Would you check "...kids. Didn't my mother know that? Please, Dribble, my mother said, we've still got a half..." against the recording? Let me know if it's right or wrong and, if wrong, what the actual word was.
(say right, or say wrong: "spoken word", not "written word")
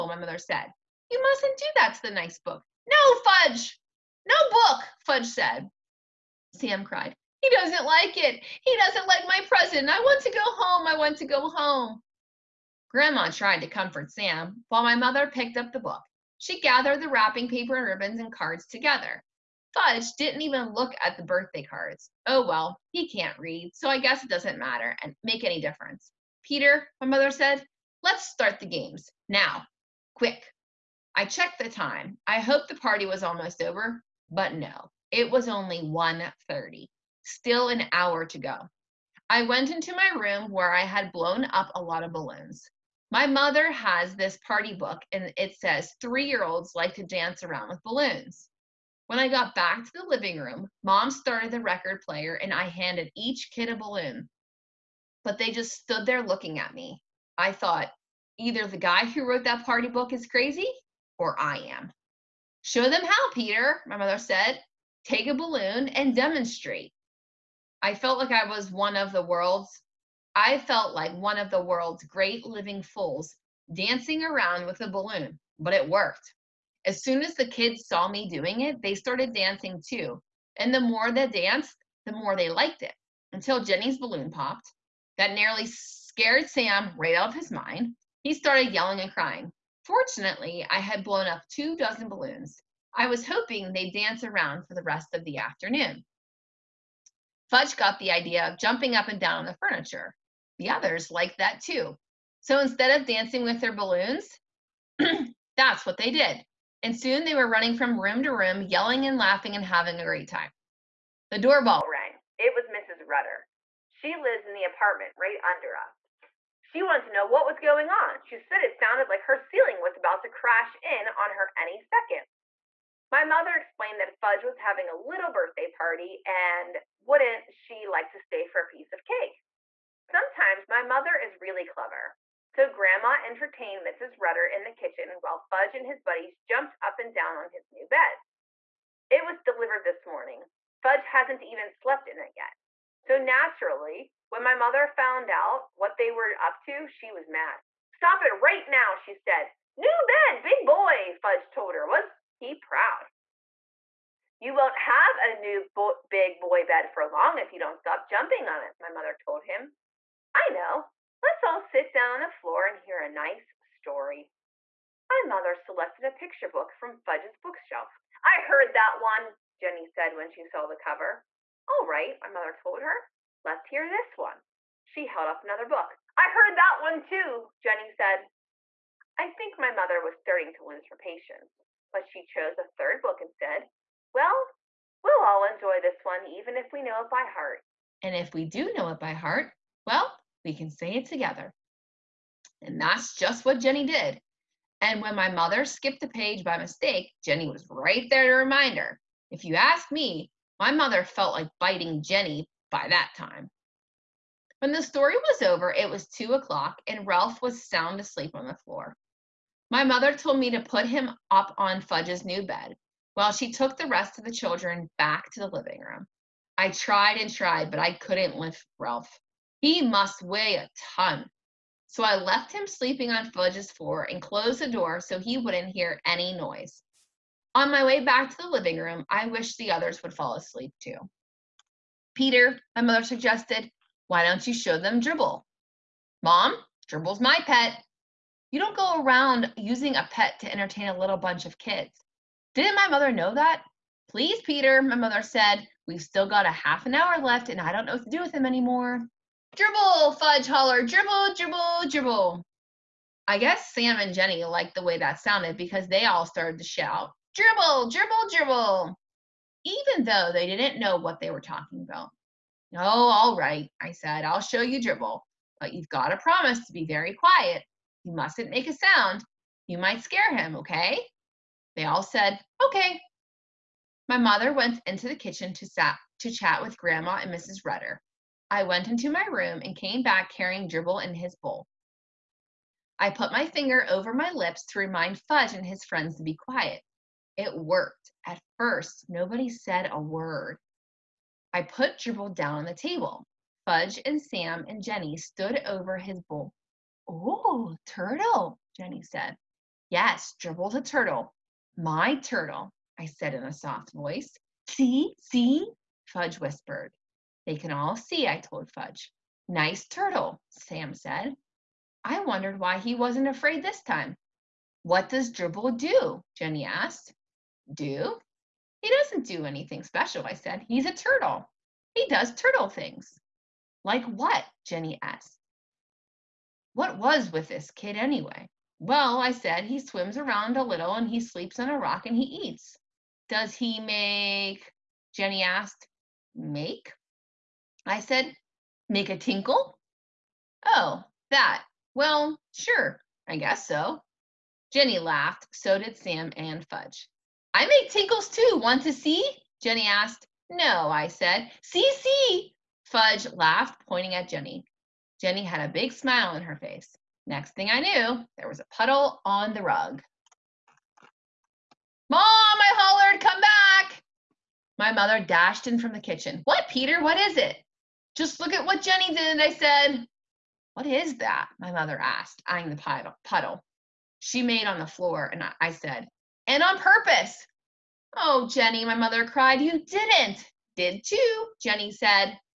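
wrong: "Peter", not "Dribble".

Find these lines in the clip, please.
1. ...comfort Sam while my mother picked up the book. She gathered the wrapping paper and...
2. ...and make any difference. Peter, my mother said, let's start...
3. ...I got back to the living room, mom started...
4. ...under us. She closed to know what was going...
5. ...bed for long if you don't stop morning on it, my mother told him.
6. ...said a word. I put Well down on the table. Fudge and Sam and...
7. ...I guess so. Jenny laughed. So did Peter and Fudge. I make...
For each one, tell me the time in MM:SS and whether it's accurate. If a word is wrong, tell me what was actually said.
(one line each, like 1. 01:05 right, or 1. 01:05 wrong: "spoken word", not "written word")
1. 00:13 right
2. 00:25 right
3. 00:49 right
4. 01:55 wrong: "wanted", not "closed"
5. 02:36 wrong: "jumping", not "morning"
6. 04:49 wrong: "Dribble", not "Well"
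7. 05:43 wrong: "Sam", not "Peter".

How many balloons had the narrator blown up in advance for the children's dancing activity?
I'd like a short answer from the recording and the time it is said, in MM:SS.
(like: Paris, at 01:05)
Two dozen, at 01:31.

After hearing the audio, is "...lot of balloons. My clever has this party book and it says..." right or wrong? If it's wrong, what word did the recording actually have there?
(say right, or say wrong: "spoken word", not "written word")
wrong: "mother", not "clever".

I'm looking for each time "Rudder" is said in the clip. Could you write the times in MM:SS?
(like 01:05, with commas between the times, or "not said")
01:53, 02:14, 04:37.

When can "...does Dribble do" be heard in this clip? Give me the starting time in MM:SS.
05:15.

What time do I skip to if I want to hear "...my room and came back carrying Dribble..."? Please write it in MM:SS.
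04:39.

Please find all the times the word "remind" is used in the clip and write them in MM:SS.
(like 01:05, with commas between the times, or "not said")
03:18, 04:44.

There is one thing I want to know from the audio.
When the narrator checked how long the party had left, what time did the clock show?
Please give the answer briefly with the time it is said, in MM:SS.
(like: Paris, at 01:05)
1:30, at 00:35.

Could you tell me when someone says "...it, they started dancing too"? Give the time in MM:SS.
01:18.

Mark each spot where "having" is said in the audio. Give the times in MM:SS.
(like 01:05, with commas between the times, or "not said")
01:49, 02:04.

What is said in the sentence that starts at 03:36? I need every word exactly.
I tried and tried, but I couldn't lift Ralph.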